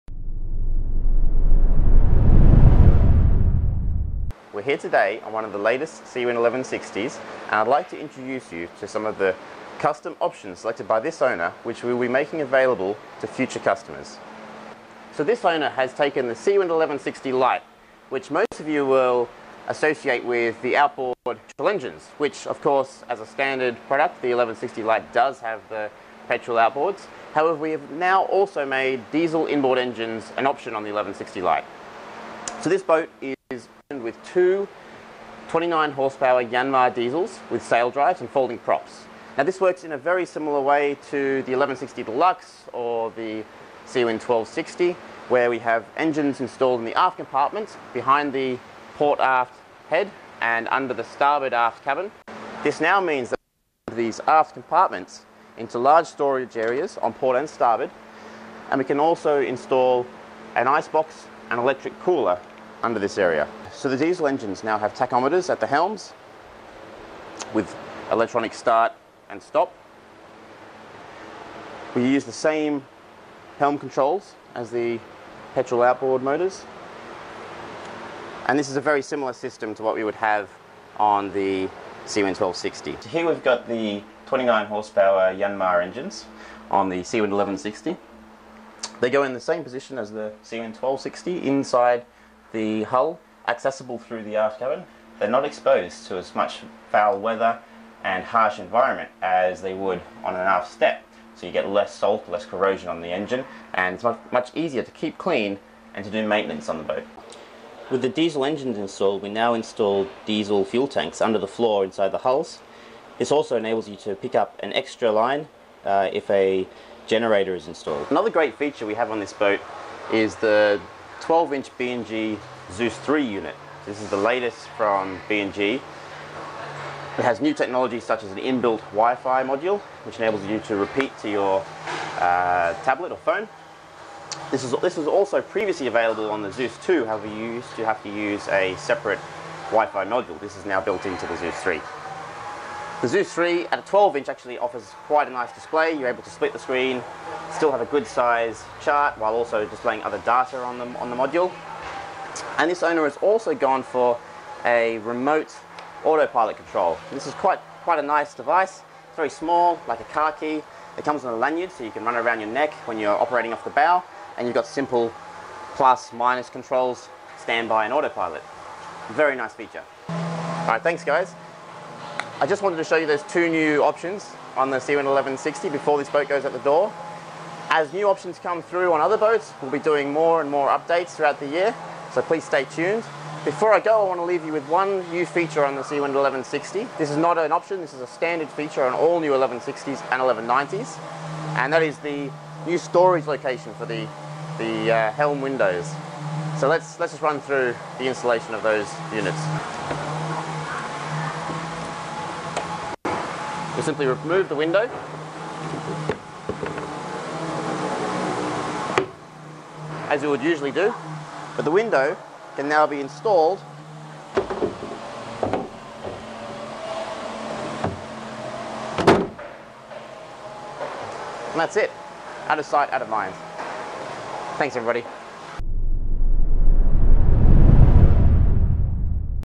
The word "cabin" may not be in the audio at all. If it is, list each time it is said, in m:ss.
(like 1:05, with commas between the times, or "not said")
0:51, 1:34.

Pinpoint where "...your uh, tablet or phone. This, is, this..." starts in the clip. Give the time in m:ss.
2:11.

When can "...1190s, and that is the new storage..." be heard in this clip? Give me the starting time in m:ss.
3:10.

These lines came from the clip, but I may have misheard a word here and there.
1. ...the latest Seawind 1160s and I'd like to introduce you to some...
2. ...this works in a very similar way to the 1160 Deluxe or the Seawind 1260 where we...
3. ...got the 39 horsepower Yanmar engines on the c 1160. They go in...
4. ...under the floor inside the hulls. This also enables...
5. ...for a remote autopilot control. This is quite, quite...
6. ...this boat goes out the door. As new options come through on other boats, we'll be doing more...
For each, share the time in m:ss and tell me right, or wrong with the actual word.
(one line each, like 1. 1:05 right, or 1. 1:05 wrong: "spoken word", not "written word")
1. 0:05 right
2. 0:39 right
3. 1:23 wrong: "29", not "39"
4. 1:51 right
5. 2:33 right
6. 2:55 right.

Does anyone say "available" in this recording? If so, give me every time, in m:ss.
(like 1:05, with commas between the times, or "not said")
0:12, 2:15.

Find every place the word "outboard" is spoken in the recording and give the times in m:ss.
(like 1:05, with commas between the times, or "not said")
0:20, 0:26, 1:15.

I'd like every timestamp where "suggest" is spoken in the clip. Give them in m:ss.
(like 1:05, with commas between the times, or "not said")
not said.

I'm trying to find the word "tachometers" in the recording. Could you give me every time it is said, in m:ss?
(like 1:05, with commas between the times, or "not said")
1:04.